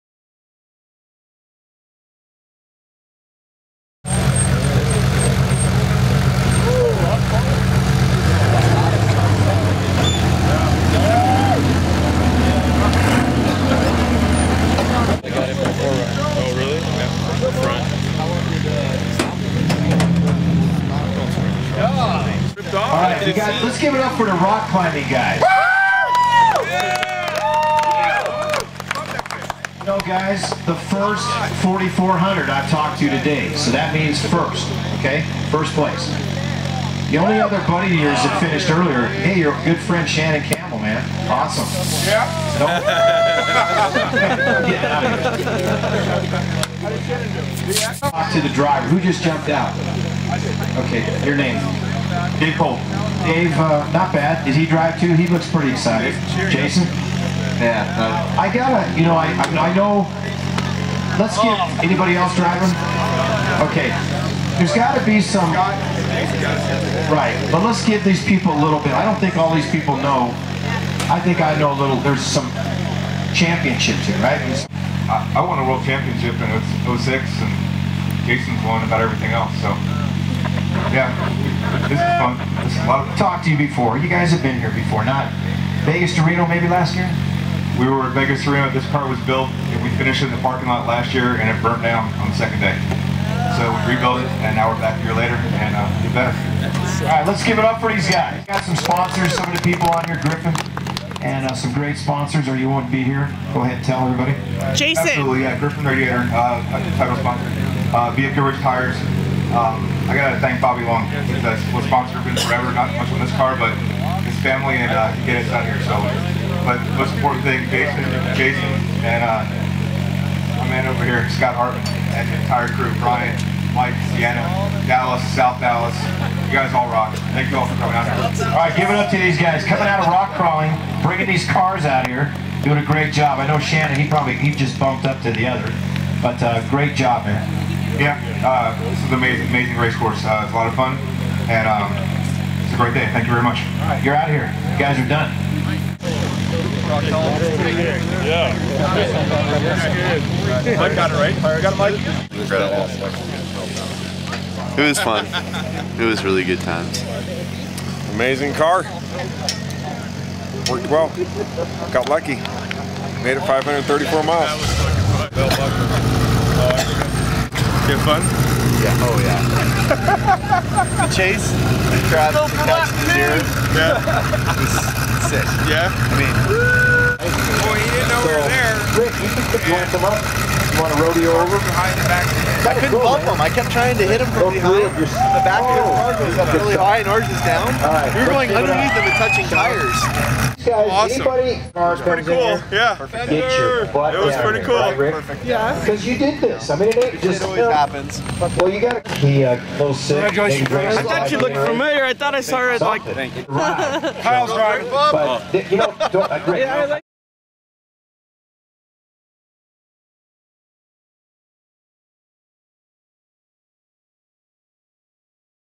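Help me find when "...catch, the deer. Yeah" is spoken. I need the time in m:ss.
2:52.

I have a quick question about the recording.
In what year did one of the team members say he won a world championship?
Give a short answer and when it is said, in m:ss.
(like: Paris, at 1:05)
2006, at 1:16.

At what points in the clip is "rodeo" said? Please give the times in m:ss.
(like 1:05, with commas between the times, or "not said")
3:01.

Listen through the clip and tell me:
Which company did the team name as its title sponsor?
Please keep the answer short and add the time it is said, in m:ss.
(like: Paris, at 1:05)
Griffin Radiator, at 1:45.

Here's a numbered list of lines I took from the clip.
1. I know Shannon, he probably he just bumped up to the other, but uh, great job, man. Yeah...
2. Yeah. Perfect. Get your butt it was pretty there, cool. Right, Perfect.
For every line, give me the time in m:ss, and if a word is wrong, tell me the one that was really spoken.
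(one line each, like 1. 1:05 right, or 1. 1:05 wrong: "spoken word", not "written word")
1. 2:13 right
2. 3:12 right.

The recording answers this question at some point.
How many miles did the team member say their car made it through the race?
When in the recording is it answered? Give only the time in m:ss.
2:43.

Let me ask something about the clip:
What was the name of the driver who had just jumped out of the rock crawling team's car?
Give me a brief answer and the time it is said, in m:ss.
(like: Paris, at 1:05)
Dave Cole, at 0:52.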